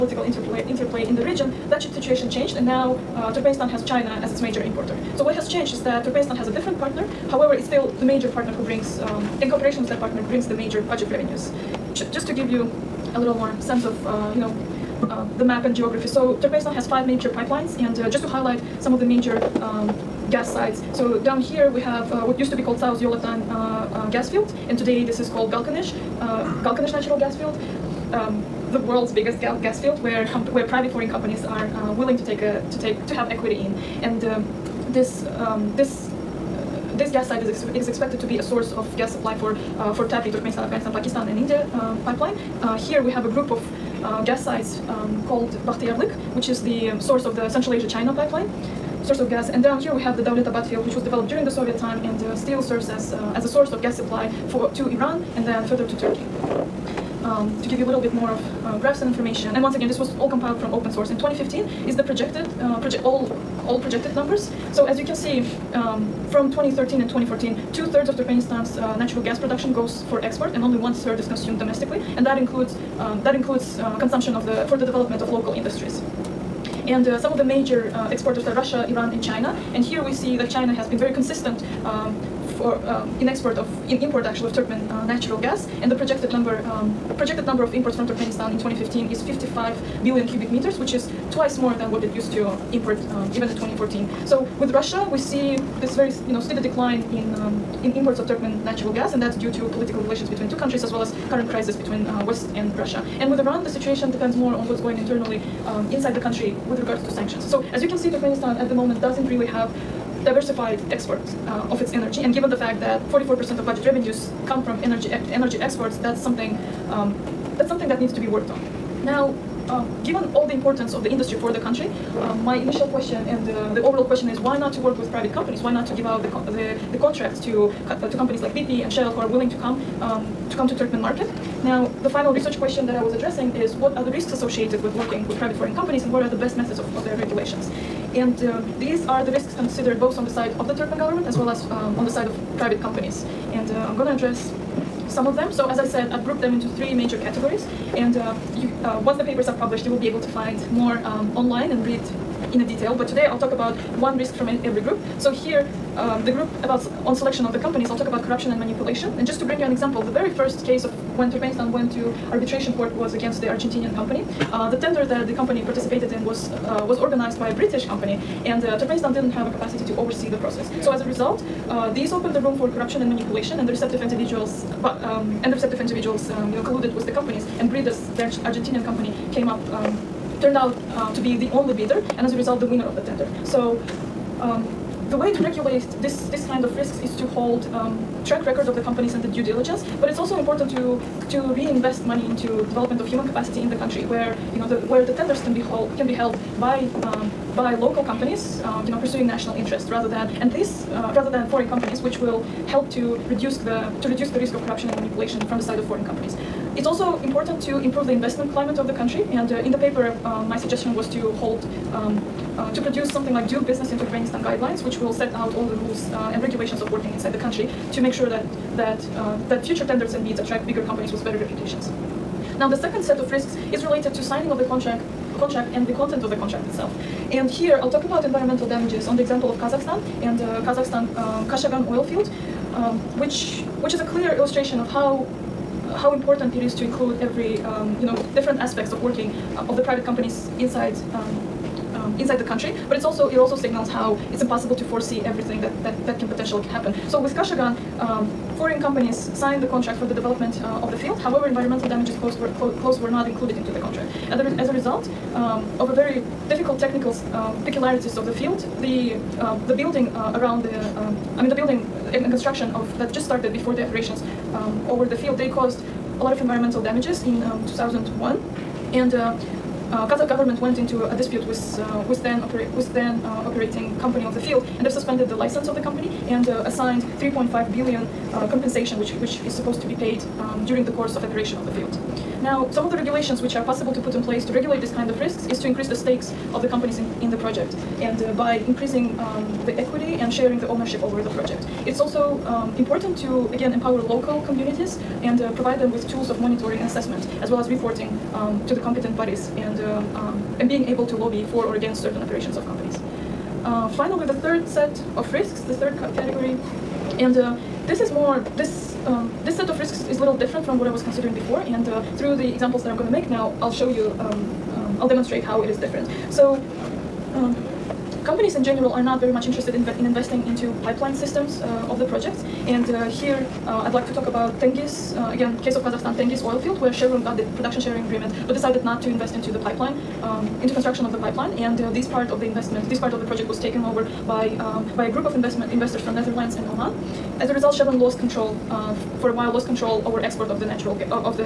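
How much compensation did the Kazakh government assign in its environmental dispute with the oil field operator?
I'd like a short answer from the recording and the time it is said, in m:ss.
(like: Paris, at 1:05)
3.5 billion, at 4:37.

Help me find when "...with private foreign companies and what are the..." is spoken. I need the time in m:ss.
2:15.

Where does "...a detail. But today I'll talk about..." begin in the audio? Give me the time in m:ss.
2:32.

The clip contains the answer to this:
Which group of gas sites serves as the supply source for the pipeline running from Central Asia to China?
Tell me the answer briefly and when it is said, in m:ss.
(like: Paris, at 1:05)
Bakhtiyarlik, at 0:45.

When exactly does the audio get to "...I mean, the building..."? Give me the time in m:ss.
4:21.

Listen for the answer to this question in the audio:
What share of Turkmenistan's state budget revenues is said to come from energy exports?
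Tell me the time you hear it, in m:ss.
1:53.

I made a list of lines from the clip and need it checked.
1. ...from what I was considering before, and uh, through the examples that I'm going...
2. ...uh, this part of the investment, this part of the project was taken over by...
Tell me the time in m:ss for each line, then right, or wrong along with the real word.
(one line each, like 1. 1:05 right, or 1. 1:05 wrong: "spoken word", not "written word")
1. 5:10 right
2. 5:31 right.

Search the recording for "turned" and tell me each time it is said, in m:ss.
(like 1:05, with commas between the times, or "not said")
3:00.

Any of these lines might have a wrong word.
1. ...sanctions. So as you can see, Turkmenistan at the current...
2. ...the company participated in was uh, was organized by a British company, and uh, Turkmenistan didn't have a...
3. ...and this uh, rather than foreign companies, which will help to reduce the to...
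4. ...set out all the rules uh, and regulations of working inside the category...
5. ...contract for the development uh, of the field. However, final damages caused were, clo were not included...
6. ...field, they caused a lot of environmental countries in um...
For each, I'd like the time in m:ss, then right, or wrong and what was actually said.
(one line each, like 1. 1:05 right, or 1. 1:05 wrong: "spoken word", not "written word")
1. 1:47 wrong: "moment", not "current"
2. 2:45 right
3. 3:20 right
4. 3:35 wrong: "country", not "category"
5. 4:09 wrong: "environmental", not "final"
6. 4:25 wrong: "damages", not "countries".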